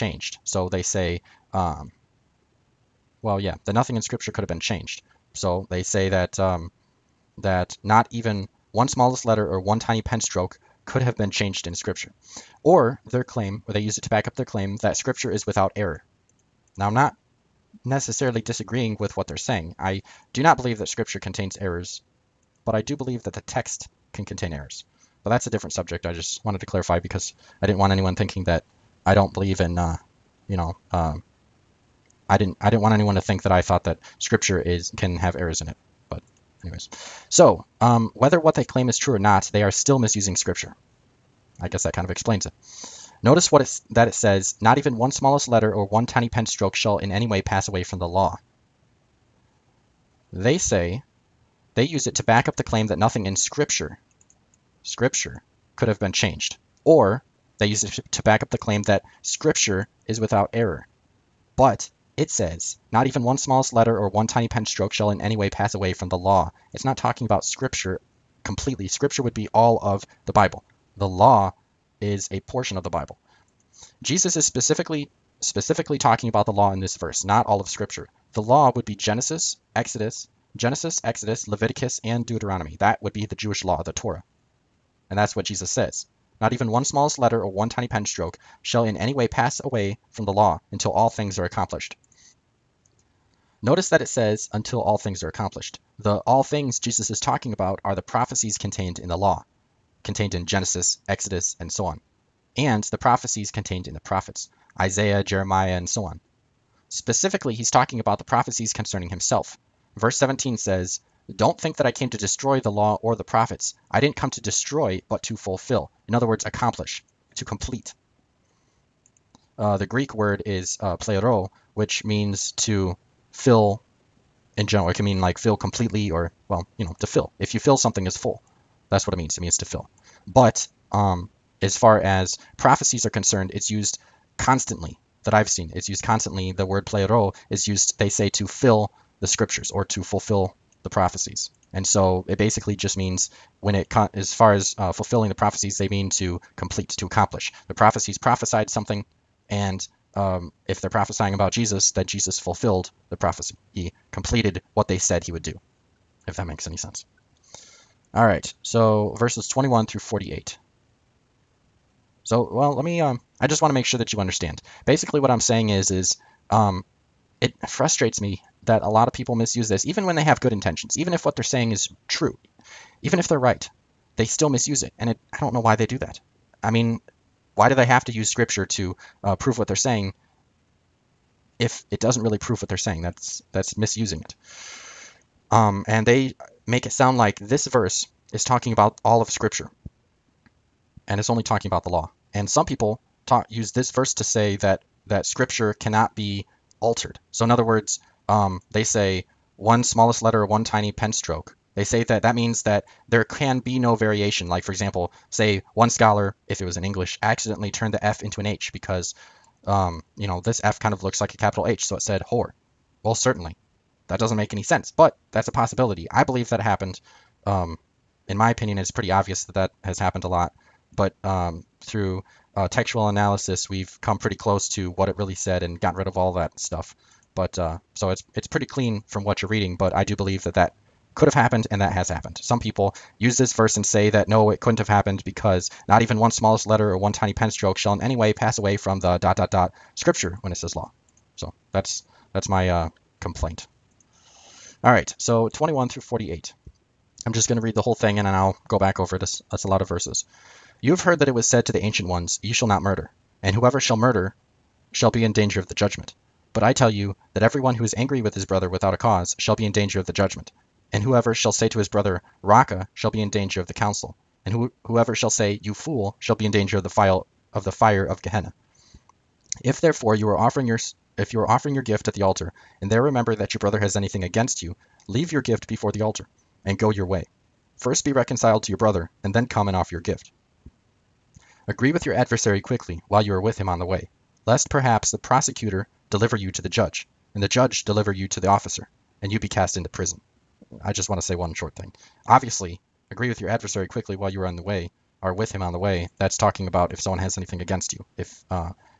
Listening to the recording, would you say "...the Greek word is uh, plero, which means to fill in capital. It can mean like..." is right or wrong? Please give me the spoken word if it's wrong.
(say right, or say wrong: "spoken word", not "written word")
wrong: "general", not "capital".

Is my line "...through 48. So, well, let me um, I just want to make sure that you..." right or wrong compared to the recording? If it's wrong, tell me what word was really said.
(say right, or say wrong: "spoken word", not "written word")
right.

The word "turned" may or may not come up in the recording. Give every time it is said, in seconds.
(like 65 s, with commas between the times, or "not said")
207 s.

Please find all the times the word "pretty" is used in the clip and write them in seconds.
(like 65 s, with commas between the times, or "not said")
218 s, 224 s, 228 s.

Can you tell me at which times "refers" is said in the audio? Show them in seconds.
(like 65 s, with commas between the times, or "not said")
not said.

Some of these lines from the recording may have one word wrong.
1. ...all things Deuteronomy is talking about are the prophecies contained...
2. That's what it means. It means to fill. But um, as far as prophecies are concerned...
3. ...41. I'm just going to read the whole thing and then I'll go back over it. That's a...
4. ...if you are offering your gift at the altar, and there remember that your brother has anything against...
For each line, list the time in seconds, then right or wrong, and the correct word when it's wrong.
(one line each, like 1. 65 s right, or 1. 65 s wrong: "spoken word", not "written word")
1. 96 s wrong: "Jesus", not "Deuteronomy"
2. 128 s right
3. 246 s wrong: "48", not "41"
4. 271 s right.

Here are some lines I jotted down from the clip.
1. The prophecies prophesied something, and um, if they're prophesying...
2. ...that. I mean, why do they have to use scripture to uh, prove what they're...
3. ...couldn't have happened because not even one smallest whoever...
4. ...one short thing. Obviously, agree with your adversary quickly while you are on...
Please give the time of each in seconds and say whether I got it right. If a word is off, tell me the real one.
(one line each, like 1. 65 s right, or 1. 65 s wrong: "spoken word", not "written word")
1. 147 s right
2. 175 s right
3. 234 s wrong: "letter", not "whoever"
4. 291 s right.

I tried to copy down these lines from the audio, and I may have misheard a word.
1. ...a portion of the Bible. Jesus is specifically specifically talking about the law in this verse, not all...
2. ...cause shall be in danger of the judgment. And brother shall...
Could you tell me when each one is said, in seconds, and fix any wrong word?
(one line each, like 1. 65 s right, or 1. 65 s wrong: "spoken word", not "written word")
1. 72 s right
2. 258 s wrong: "whoever", not "brother".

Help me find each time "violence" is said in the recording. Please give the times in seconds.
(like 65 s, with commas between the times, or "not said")
not said.